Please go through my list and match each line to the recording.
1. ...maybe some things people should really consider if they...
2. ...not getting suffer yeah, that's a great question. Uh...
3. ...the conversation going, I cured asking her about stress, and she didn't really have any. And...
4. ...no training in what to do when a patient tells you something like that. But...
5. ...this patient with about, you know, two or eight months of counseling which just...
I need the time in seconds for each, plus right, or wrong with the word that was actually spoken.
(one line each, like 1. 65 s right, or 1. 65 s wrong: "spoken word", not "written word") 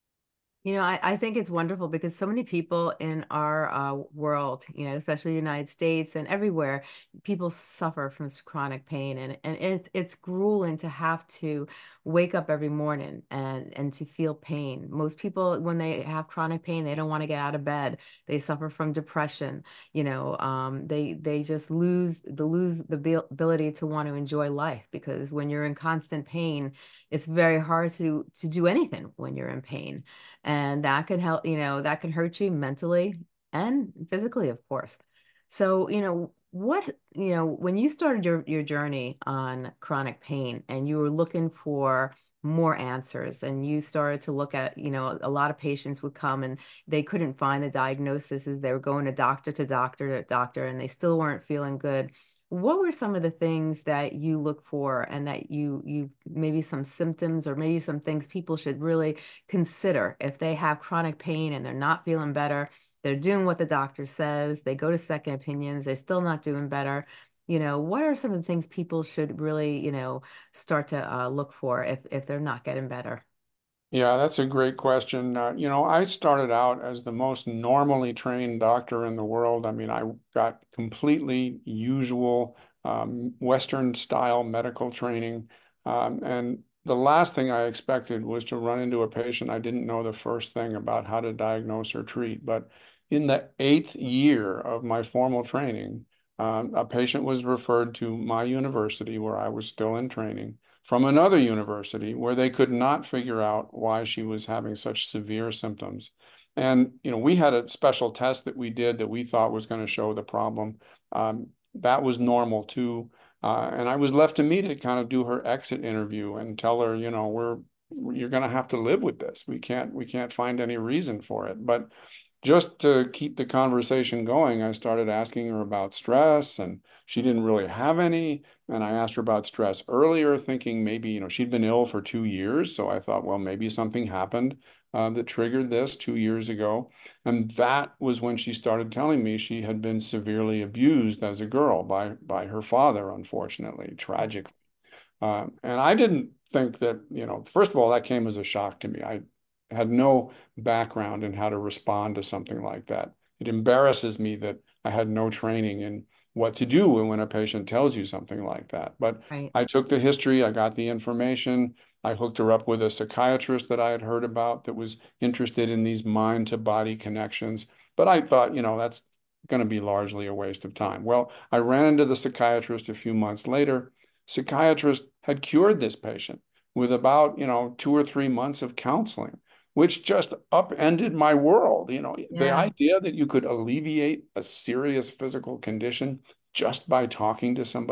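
1. 57 s right
2. 72 s wrong: "better", not "suffer"
3. 123 s wrong: "started", not "cured"
4. 155 s right
5. 175 s wrong: "three", not "eight".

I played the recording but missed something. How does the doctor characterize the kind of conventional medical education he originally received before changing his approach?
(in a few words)
Western style.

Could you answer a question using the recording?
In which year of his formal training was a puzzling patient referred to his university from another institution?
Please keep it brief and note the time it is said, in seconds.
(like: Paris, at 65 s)
8th year, at 93 s.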